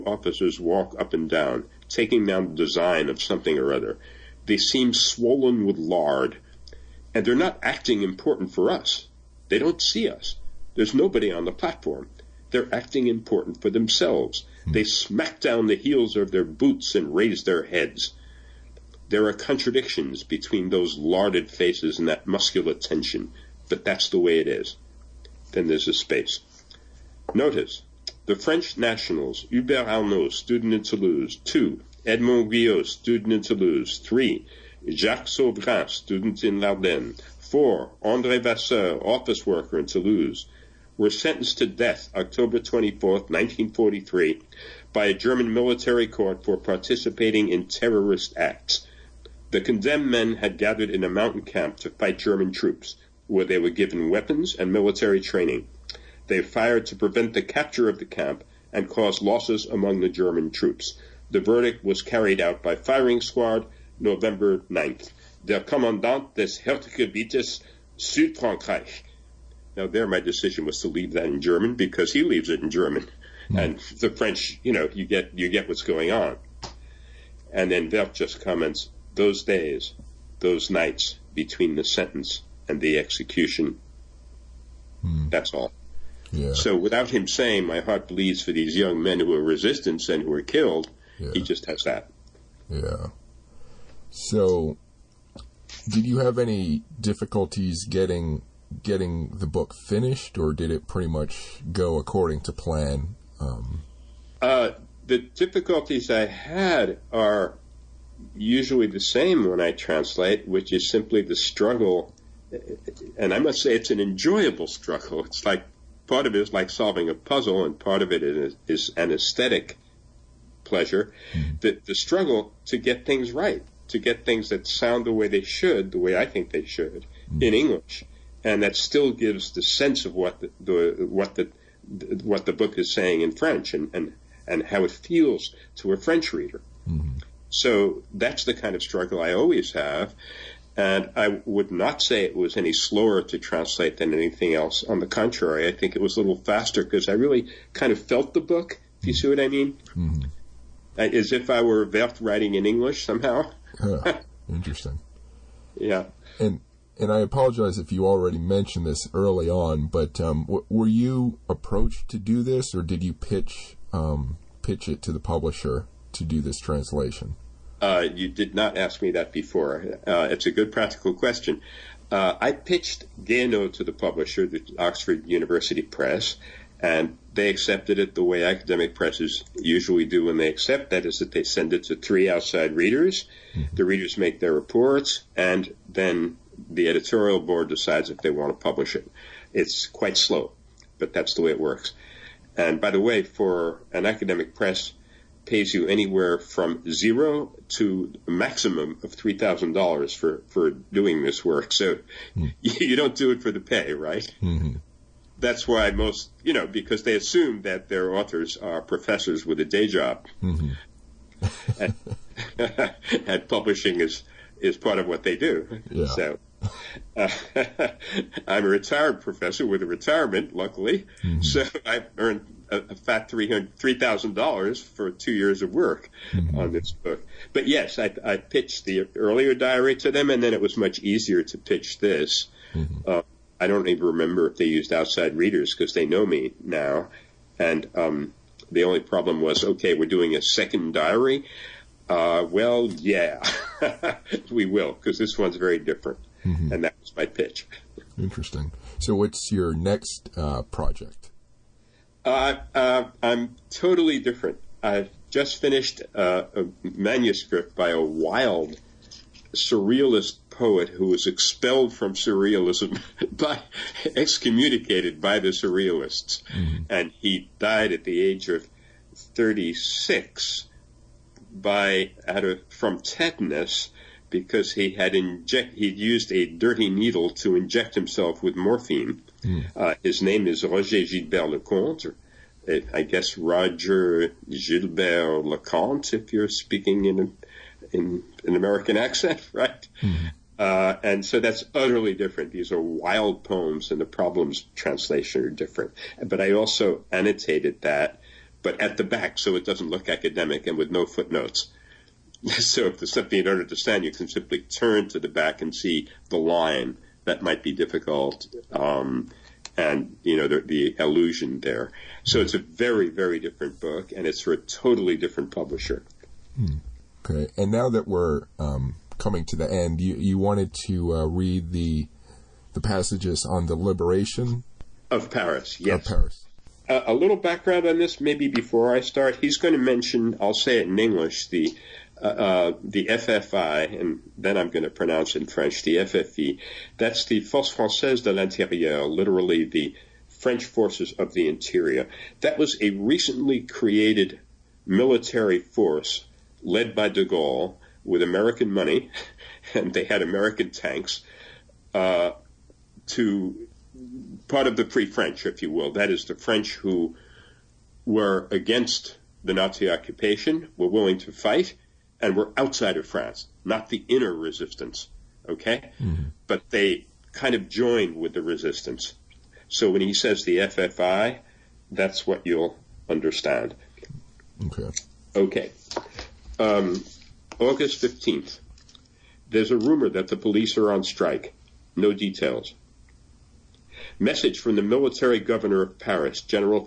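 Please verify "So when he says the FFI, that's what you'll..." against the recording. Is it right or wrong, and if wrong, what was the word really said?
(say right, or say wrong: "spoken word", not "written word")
right.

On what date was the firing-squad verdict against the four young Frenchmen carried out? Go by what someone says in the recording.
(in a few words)
November 9th.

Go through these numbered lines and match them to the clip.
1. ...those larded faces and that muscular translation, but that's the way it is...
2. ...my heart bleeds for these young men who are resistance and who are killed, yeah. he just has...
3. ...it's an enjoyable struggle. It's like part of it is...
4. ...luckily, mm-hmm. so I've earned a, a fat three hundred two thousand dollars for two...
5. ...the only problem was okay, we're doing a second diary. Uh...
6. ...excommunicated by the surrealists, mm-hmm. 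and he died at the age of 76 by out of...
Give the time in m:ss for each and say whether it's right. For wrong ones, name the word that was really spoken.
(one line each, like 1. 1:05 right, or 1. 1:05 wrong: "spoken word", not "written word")
1. 0:20 wrong: "tension", not "translation"
2. 1:27 right
3. 1:53 right
4. 3:40 wrong: "three", not "two"
5. 3:58 right
6. 4:24 wrong: "36", not "76".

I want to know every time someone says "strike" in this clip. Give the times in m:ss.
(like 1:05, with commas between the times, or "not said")
6:21.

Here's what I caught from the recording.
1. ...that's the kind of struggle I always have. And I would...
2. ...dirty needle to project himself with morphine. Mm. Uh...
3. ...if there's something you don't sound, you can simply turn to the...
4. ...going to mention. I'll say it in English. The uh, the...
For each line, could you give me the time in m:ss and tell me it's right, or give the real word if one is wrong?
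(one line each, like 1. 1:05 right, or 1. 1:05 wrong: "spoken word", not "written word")
1. 2:18 right
2. 4:36 wrong: "inject", not "project"
3. 5:02 wrong: "understand", not "sound"
4. 5:29 right.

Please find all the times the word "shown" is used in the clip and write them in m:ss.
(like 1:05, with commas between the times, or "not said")
not said.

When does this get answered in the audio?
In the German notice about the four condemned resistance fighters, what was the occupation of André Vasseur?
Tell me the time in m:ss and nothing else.
0:39.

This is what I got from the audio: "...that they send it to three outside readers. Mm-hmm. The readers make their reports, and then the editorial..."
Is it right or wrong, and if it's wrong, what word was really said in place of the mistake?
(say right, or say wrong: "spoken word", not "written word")
right.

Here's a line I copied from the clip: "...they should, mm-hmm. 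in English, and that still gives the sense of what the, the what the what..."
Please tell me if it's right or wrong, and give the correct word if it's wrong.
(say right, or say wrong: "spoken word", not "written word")
right.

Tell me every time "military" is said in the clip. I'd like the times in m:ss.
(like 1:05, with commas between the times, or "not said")
0:45, 0:54, 5:44, 6:24.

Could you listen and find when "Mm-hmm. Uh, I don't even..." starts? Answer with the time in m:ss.
3:52.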